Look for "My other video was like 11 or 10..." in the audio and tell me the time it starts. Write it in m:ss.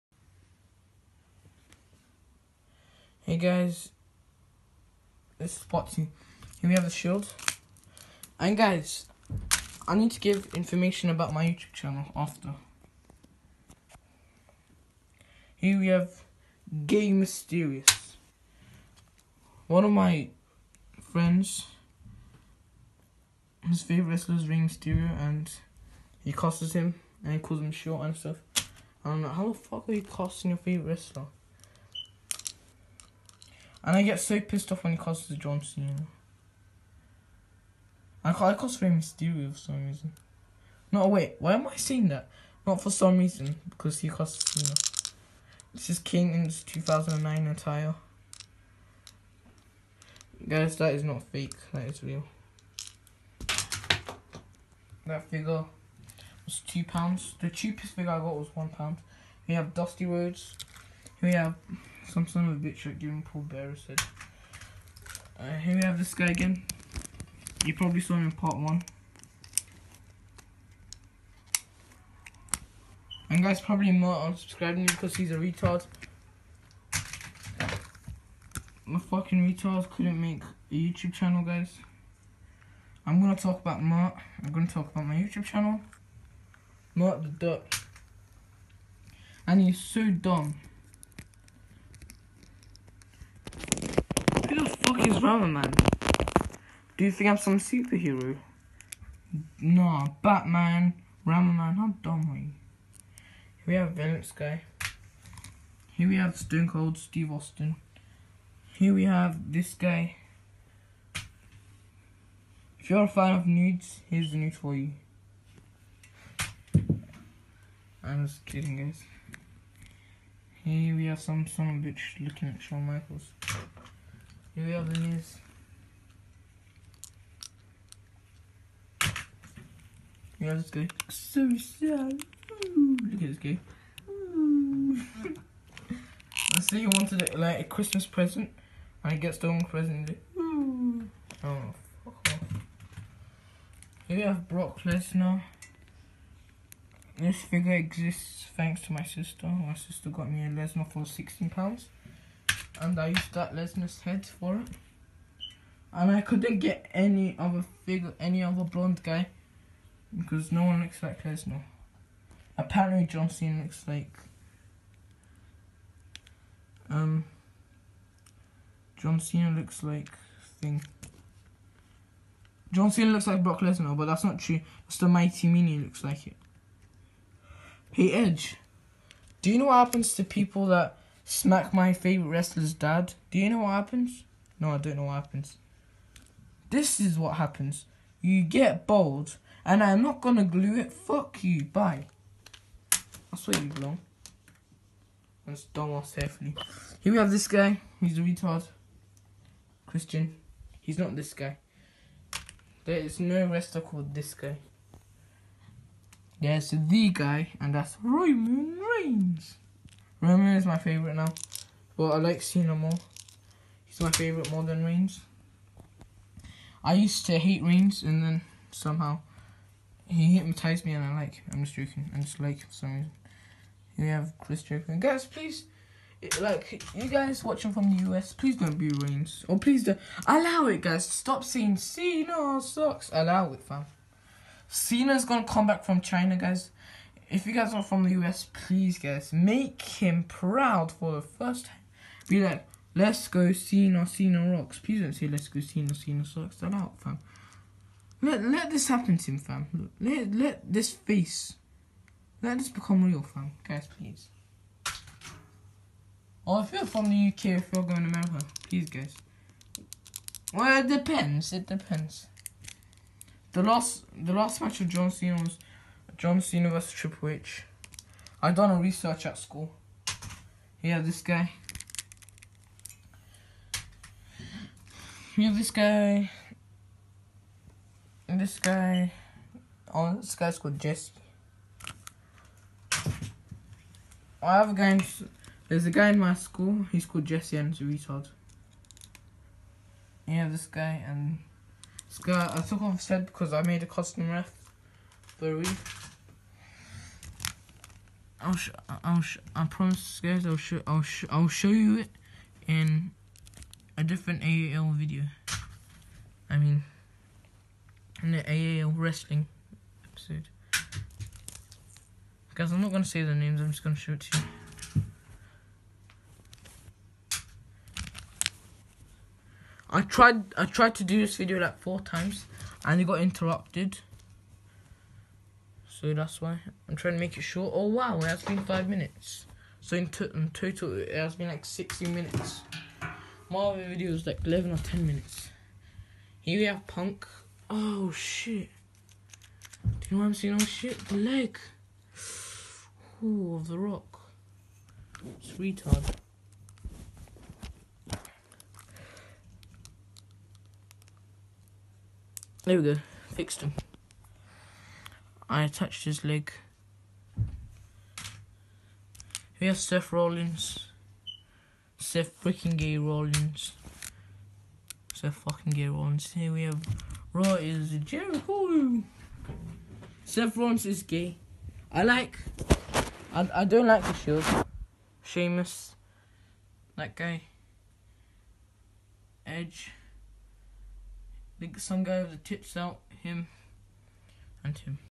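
5:33.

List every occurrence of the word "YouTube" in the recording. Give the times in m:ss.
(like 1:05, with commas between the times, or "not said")
0:11, 1:20, 1:25.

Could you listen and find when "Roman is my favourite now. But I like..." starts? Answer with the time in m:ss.
3:30.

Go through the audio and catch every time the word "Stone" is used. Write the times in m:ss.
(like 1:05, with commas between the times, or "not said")
1:46.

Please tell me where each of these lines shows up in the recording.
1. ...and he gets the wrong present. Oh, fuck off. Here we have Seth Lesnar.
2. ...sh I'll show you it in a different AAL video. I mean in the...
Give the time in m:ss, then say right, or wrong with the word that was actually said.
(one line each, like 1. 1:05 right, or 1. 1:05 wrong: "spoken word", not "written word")
1. 2:19 wrong: "Brock", not "Seth"
2. 5:01 right.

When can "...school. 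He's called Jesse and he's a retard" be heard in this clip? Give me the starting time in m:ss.
4:46.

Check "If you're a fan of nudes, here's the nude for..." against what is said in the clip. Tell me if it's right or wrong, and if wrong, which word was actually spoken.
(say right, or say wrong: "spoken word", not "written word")
right.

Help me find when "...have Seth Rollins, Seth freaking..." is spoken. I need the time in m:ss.
5:59.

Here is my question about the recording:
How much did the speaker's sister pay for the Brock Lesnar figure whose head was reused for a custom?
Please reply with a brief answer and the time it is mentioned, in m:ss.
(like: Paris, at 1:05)
16 pounds, at 2:31.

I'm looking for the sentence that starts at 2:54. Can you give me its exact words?
It's the Mighty Mini looks like it.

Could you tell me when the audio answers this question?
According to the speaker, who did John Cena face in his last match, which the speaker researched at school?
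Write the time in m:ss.
4:26.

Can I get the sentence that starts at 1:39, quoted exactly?
Nah, Batman, Ramaman, how dumb are you?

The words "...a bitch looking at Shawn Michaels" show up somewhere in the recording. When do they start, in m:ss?
2:01.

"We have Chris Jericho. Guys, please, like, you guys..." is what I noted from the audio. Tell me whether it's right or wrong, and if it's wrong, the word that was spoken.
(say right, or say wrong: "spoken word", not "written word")
right.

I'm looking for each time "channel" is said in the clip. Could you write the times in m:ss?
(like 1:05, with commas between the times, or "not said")
0:11, 1:21, 1:25.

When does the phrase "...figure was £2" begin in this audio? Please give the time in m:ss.
0:55.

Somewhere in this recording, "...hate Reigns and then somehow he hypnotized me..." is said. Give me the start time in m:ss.
3:37.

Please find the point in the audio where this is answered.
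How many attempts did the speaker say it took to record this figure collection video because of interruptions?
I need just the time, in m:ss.
5:21.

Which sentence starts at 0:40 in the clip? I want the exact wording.
No, wait, why am I saying that?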